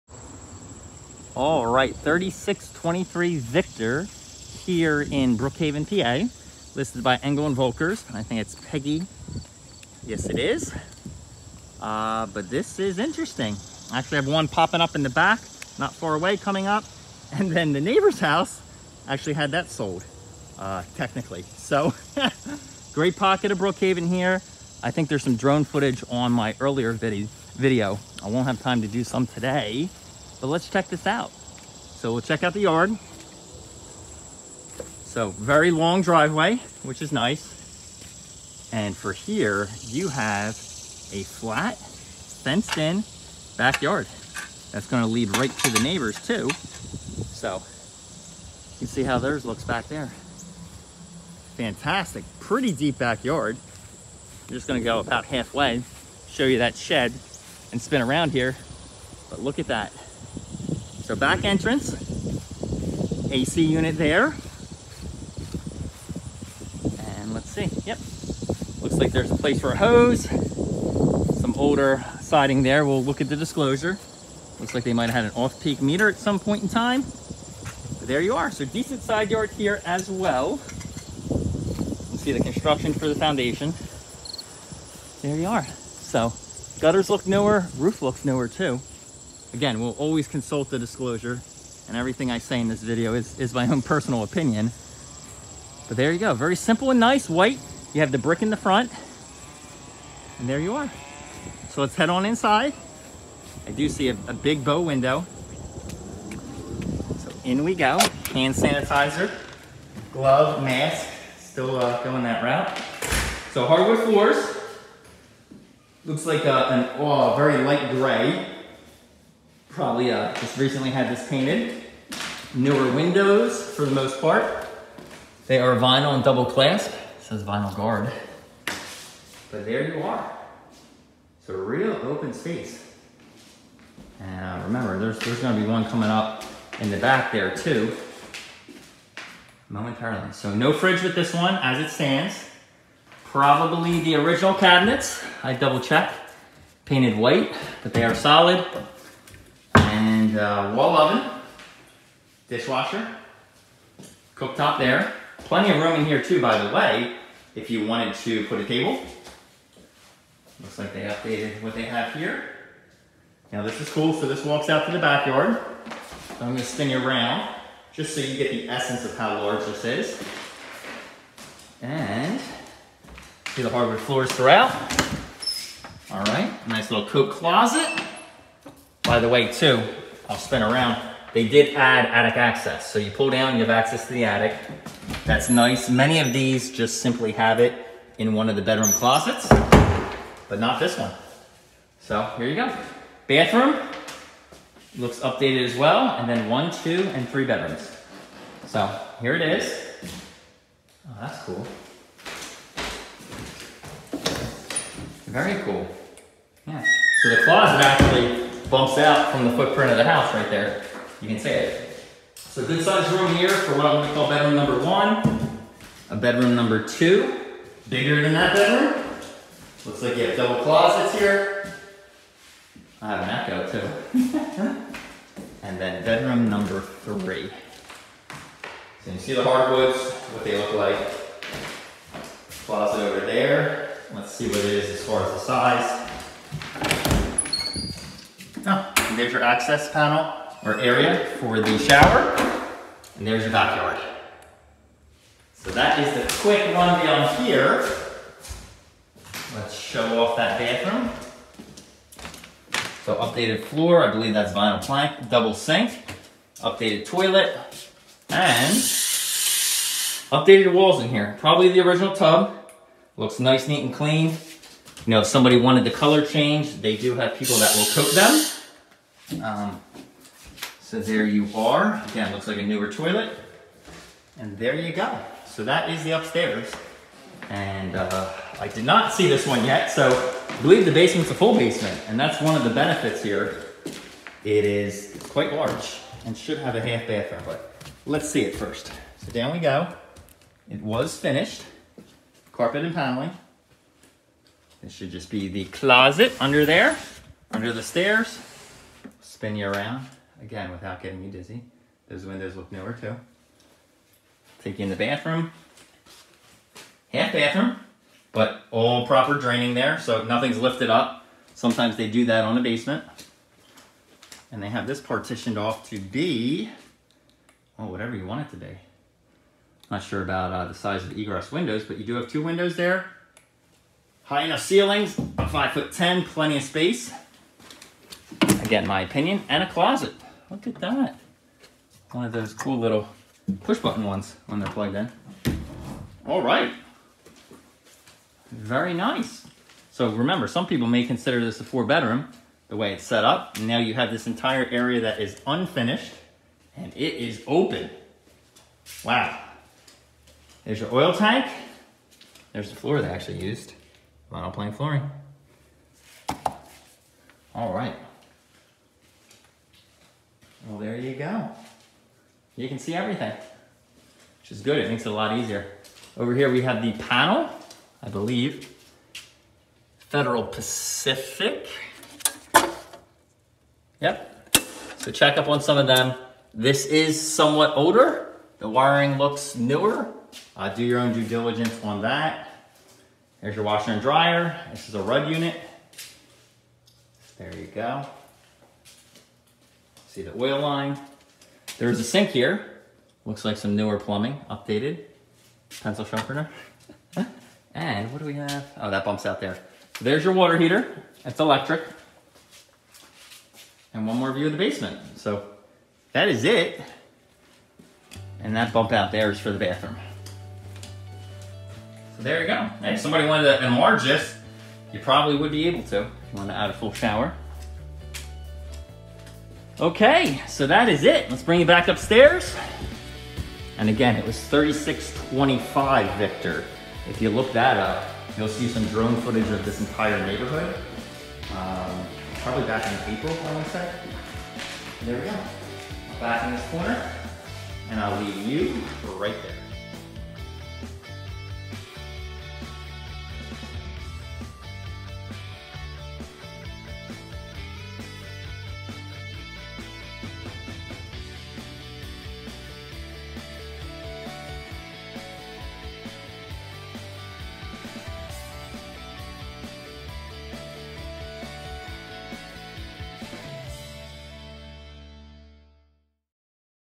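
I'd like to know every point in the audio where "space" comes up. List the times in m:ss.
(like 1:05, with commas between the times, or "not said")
2:12, 5:26.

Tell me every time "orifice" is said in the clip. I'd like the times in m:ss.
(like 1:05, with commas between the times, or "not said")
not said.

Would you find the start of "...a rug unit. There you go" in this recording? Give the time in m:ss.
6:24.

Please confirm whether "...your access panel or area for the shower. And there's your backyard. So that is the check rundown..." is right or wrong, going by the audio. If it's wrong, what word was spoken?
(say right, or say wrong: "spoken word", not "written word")
wrong: "quick", not "check".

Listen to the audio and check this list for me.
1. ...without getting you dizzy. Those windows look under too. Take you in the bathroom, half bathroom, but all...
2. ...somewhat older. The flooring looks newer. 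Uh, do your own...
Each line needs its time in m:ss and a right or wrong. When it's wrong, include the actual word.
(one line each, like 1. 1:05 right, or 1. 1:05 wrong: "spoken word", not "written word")
1. 5:00 wrong: "newer", not "under"
2. 6:17 wrong: "wiring", not "flooring".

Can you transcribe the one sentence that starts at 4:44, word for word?
It is quite large and should have a half bathroom, but let's see it first.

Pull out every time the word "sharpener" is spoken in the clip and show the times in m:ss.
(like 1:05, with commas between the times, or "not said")
6:36.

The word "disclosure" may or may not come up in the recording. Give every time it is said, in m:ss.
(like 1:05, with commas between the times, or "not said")
1:13, 1:30.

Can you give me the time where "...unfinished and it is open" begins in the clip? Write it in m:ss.
5:45.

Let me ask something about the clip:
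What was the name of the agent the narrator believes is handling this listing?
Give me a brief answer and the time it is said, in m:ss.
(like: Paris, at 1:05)
Peggy, at 0:08.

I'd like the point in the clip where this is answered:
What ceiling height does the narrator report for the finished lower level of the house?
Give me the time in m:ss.
5:25.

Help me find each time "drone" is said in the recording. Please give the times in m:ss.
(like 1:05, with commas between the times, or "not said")
0:25, 7:08.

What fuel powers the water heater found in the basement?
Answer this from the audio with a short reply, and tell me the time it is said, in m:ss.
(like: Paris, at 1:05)
Electric, at 6:41.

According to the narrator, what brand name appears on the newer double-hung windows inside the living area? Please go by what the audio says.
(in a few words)
Vinyl Guard.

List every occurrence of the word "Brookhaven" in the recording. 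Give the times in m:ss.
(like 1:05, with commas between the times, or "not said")
0:05, 0:23.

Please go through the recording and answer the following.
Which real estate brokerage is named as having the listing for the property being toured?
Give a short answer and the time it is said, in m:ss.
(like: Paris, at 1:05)
Engel and Volkers, at 0:07.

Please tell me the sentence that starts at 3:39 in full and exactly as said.
Looks like you have double closets here.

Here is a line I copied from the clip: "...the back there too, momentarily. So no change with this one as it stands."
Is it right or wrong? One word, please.
wrong.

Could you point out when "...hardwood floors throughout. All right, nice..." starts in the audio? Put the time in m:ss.
2:53.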